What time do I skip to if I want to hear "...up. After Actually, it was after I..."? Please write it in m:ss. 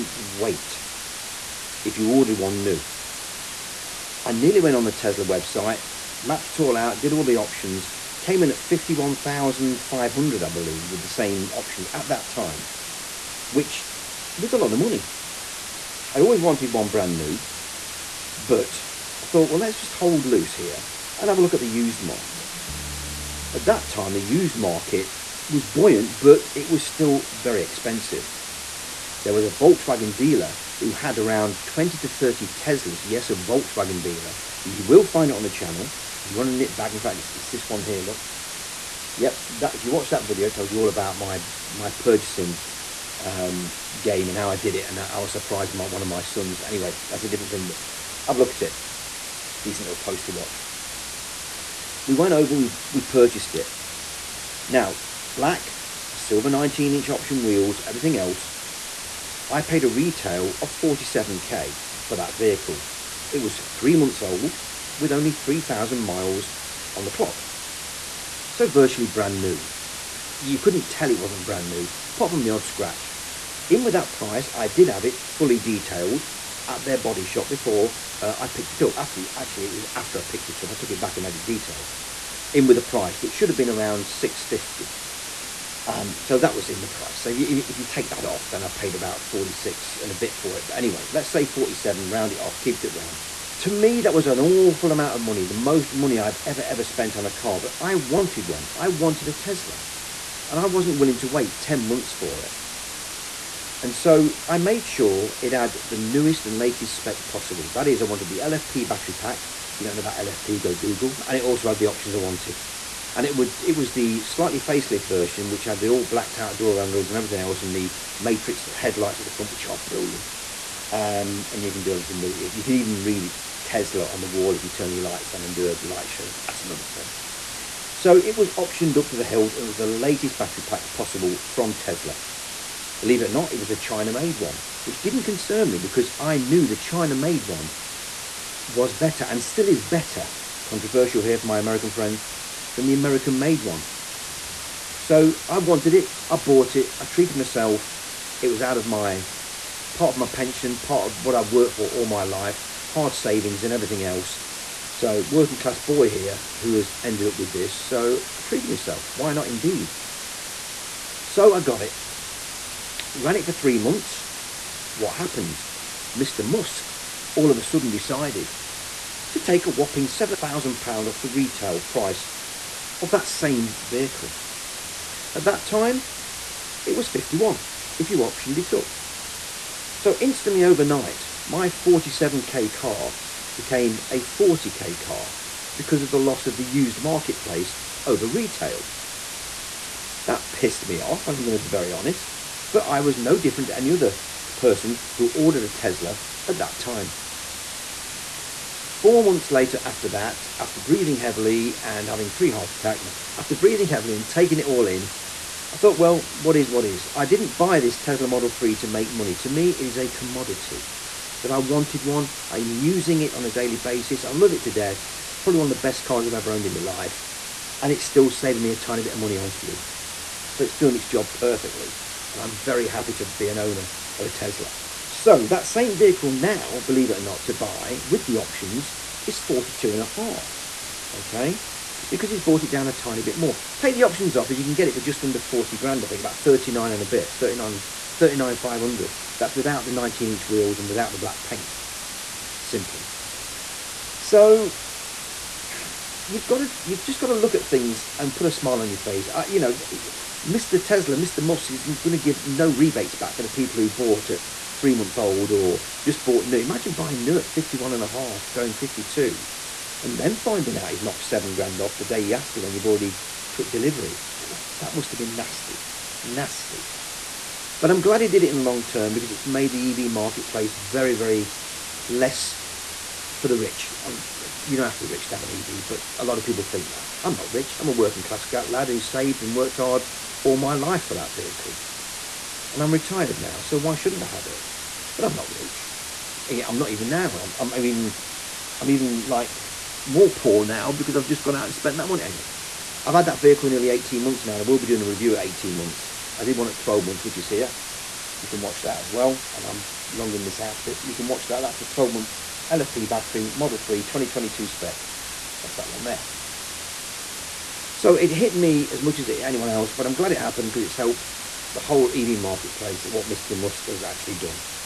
1:18.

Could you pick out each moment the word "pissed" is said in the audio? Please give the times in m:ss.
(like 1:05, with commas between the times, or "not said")
3:10.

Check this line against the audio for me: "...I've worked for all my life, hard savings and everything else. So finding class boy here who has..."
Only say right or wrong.
wrong.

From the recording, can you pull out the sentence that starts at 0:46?
Anyway, that's a different thing, but I've looked at it.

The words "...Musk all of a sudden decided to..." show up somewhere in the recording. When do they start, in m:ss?
2:46.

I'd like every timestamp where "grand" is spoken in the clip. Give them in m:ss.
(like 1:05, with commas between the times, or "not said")
3:55, 4:21.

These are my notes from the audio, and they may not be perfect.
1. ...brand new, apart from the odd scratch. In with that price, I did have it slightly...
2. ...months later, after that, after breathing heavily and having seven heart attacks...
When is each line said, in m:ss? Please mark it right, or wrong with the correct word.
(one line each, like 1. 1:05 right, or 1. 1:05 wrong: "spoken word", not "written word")
1. 1:11 wrong: "fully", not "slightly"
2. 3:19 wrong: "three", not "seven".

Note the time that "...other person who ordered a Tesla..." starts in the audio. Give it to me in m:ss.
3:13.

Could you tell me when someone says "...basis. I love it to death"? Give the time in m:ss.
3:33.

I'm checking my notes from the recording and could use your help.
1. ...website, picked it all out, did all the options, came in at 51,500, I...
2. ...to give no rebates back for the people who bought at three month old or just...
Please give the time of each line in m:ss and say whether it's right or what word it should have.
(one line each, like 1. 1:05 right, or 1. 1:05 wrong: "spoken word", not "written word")
1. 0:05 wrong: "mapped", not "picked"
2. 4:12 right.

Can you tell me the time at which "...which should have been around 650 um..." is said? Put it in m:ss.
1:23.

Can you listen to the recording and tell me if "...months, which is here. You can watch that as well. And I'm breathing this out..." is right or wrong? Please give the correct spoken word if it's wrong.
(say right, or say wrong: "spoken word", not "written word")
wrong: "longing", not "breathing".